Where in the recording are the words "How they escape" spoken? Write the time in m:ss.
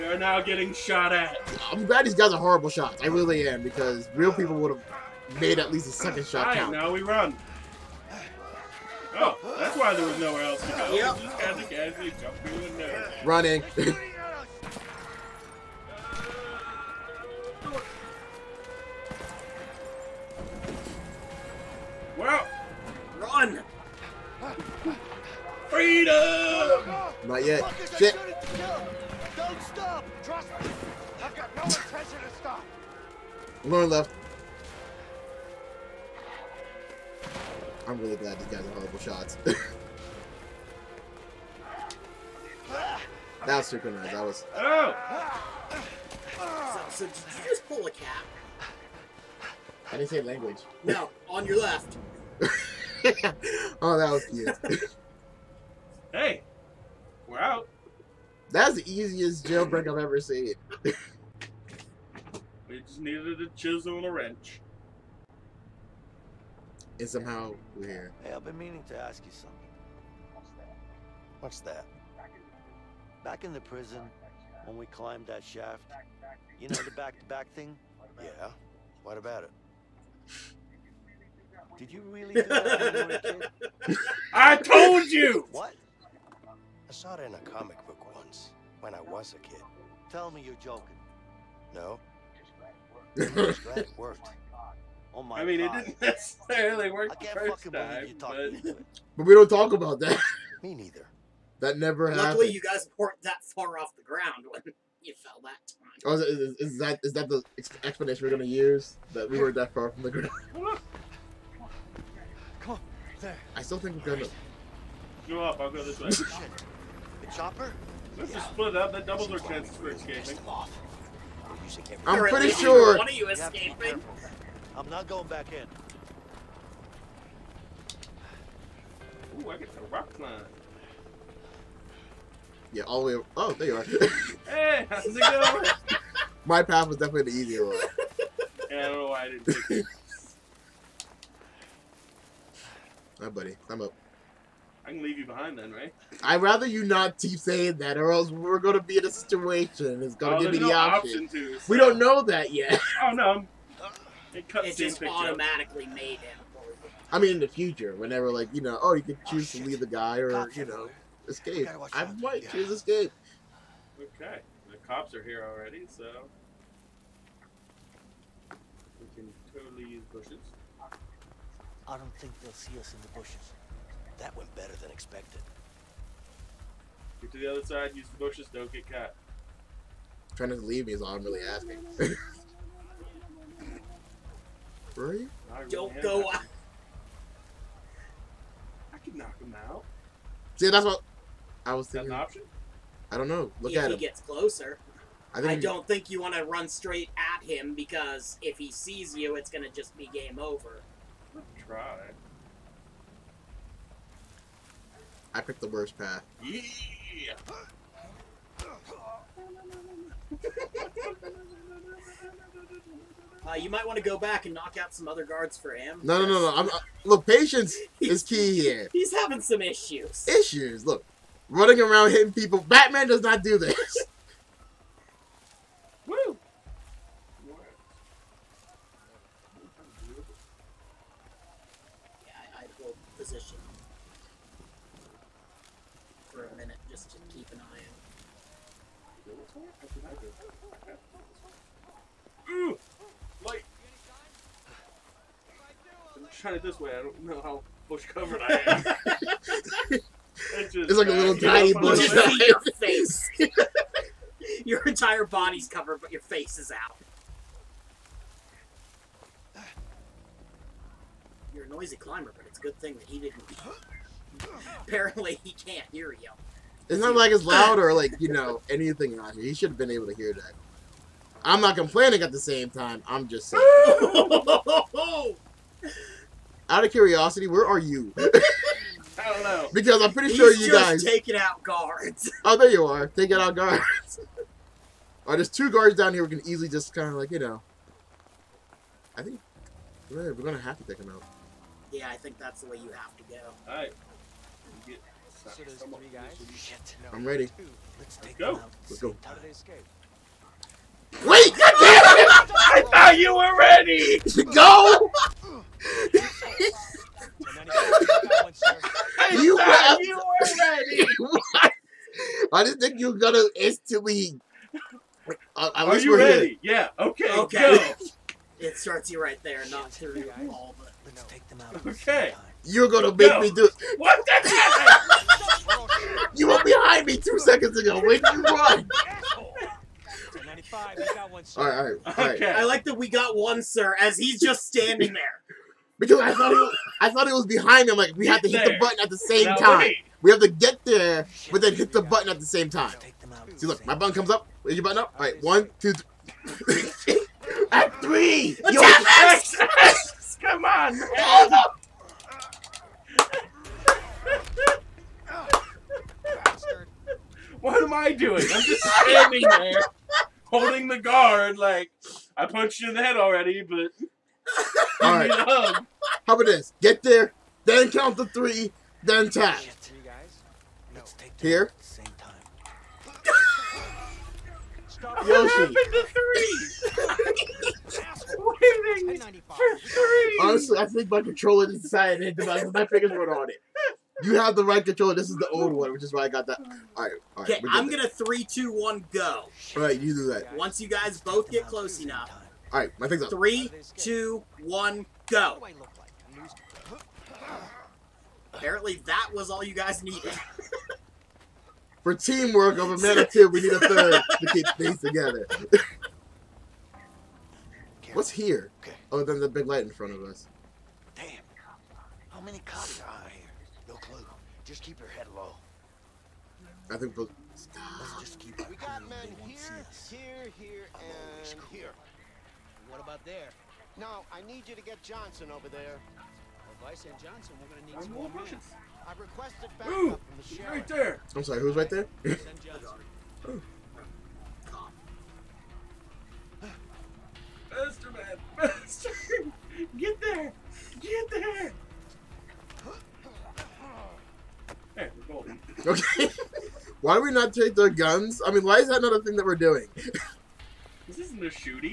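4:59.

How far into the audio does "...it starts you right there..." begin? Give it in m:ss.
5:18.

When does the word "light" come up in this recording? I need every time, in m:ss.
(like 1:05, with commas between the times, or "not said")
4:03, 6:49.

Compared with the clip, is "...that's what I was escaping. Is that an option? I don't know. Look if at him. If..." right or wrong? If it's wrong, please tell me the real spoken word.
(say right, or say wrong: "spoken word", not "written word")
wrong: "thinking", not "escaping".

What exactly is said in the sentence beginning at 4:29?
He should have been able to hear that.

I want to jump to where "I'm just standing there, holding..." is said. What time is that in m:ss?
5:58.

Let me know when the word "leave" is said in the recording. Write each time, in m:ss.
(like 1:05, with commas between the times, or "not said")
2:25, 2:39, 3:00.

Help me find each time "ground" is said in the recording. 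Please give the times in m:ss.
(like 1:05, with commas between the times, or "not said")
1:44, 1:50.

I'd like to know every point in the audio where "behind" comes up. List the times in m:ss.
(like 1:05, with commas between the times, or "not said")
2:25, 5:26, 5:37.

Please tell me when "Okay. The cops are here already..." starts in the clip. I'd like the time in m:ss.
2:44.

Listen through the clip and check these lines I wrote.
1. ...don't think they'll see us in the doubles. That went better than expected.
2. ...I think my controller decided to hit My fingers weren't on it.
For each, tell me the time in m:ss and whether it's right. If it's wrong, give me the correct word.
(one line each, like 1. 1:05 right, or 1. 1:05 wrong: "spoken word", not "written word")
1. 2:51 wrong: "bushes", not "doubles"
2. 6:20 right.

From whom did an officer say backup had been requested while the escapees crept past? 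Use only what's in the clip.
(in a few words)
The sheriff.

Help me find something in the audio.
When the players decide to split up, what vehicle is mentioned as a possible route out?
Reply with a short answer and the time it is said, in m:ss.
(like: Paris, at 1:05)
The chopper, at 1:56.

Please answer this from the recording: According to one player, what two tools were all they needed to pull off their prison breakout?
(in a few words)
A chisel and a wrench.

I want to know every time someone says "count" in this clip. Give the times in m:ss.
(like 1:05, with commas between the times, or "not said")
0:06, 6:07.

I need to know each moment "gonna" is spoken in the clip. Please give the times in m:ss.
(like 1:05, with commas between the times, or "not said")
1:48, 1:54, 4:50, 5:13, 5:22, 6:27, 7:07.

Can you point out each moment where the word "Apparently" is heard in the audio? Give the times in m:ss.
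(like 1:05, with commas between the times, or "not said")
4:24, 6:38.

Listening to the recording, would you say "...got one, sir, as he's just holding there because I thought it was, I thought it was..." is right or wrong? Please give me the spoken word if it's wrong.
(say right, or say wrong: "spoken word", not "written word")
wrong: "standing", not "holding".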